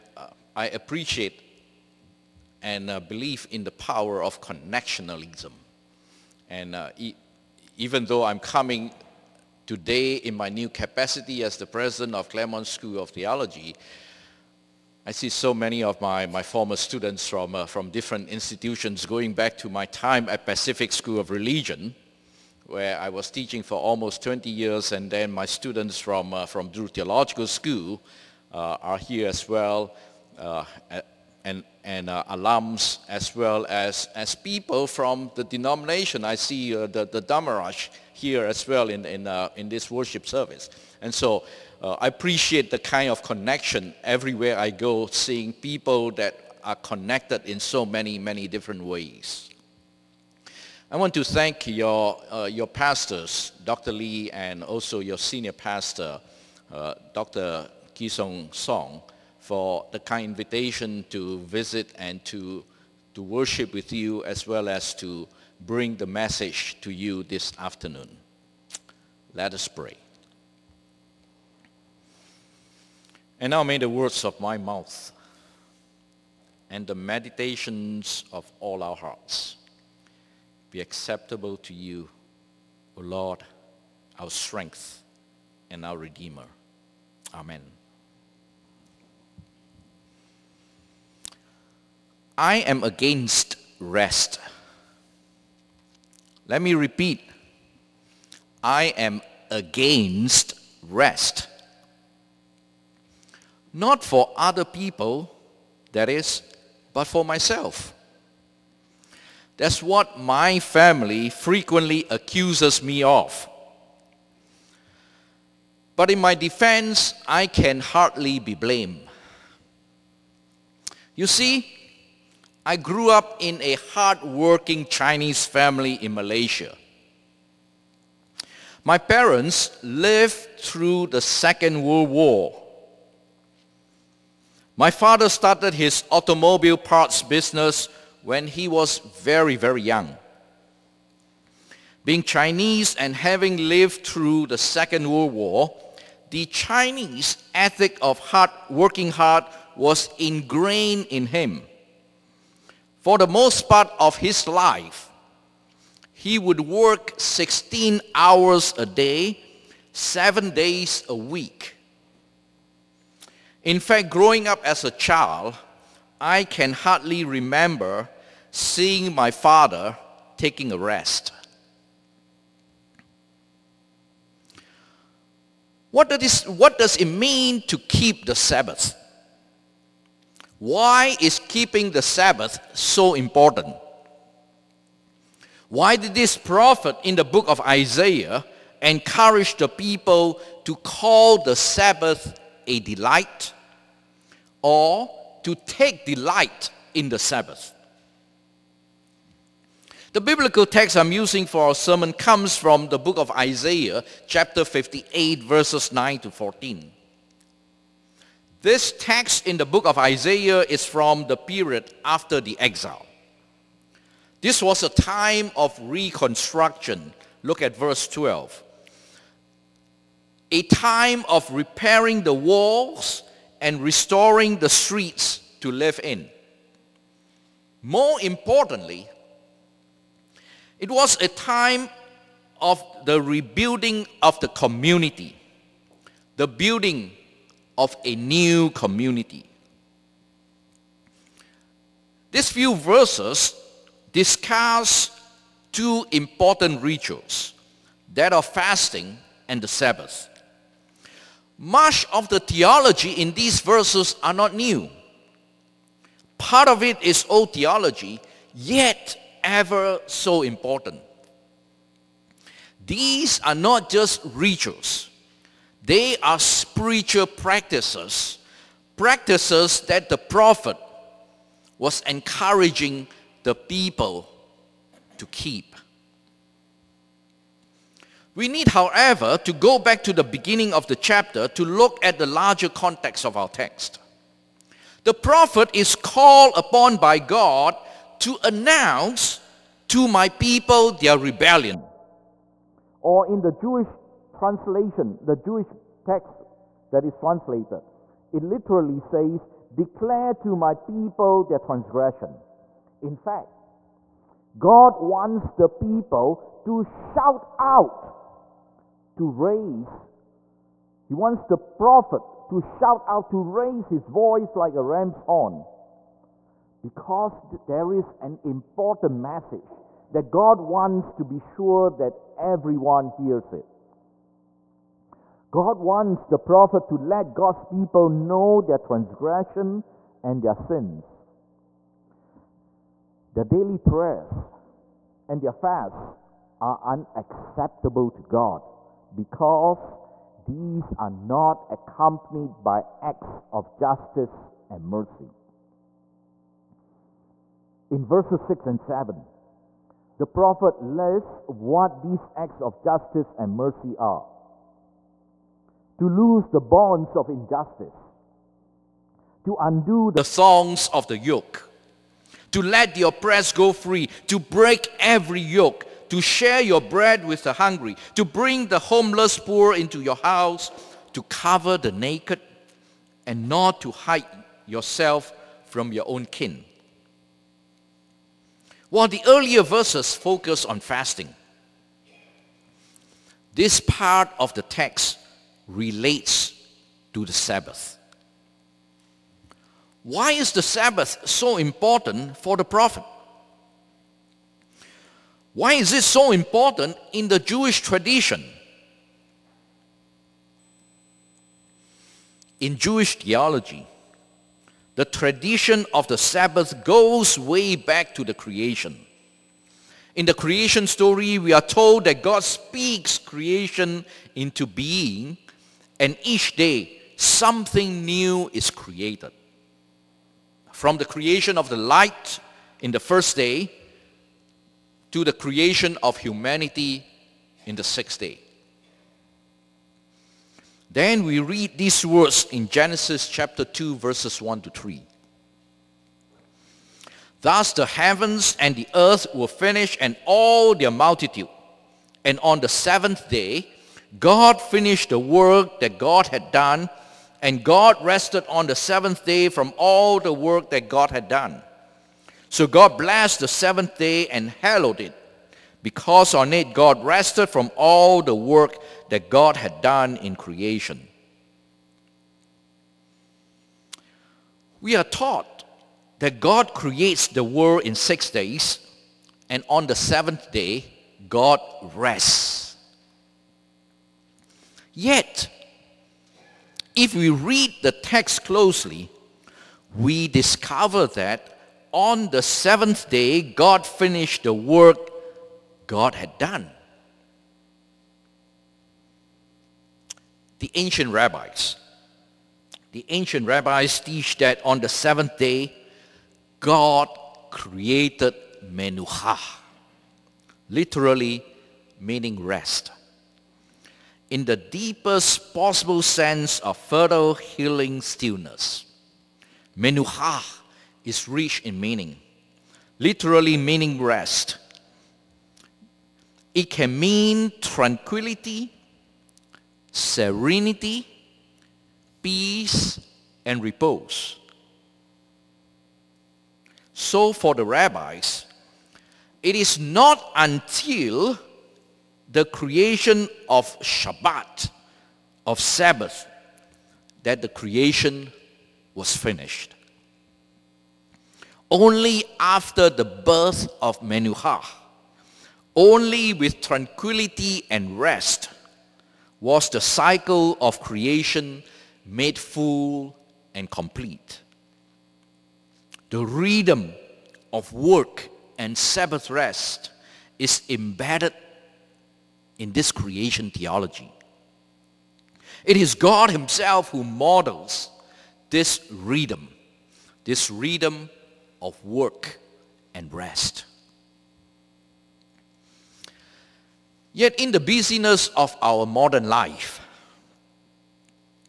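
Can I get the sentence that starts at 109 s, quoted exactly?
That's what my family frequently accuses me of.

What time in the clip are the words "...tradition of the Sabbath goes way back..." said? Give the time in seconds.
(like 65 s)
405 s.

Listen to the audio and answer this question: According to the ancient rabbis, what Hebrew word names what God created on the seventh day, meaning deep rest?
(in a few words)
Menucha.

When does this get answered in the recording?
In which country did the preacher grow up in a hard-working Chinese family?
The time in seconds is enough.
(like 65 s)
126 s.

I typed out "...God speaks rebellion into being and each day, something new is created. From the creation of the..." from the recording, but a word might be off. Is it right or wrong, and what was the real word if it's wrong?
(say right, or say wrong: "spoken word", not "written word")
wrong: "creation", not "rebellion".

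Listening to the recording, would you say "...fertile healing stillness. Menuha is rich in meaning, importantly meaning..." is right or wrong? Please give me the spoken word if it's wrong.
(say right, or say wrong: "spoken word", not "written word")
wrong: "literally", not "importantly".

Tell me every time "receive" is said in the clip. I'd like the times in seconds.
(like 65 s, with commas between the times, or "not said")
not said.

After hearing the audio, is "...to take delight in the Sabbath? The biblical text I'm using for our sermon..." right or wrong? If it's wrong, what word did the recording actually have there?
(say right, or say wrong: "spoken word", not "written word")
right.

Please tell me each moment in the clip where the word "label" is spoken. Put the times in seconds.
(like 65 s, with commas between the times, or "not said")
not said.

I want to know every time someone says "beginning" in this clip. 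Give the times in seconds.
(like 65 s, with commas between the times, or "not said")
280 s.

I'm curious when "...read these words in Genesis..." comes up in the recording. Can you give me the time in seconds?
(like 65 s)
431 s.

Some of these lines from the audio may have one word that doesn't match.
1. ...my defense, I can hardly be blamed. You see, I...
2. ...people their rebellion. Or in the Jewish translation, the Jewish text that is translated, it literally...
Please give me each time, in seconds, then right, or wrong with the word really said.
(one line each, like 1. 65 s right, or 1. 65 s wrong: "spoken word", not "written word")
1. 116 s right
2. 290 s right.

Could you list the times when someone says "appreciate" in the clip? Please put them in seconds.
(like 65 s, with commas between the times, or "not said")
0 s, 42 s.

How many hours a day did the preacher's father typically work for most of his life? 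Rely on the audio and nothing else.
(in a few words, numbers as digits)
16.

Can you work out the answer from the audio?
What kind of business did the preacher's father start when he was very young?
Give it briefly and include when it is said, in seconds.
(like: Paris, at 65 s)
automobile parts, at 136 s.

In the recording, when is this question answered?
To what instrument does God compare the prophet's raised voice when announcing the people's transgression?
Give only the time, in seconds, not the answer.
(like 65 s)
314 s.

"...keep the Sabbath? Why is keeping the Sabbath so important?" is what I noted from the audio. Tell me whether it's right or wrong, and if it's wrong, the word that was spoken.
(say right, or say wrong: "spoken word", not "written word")
right.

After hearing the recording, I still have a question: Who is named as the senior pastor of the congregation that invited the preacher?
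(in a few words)
Dr. Kisong Song.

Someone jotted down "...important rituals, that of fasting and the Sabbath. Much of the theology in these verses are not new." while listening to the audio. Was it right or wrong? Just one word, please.
right.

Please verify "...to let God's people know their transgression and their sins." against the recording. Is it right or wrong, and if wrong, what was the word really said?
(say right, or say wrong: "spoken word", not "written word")
right.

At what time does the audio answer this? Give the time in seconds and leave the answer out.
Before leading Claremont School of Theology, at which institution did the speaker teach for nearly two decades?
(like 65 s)
20 s.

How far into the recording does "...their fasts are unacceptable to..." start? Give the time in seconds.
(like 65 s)
335 s.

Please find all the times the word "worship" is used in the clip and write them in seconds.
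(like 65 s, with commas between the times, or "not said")
39 s, 63 s.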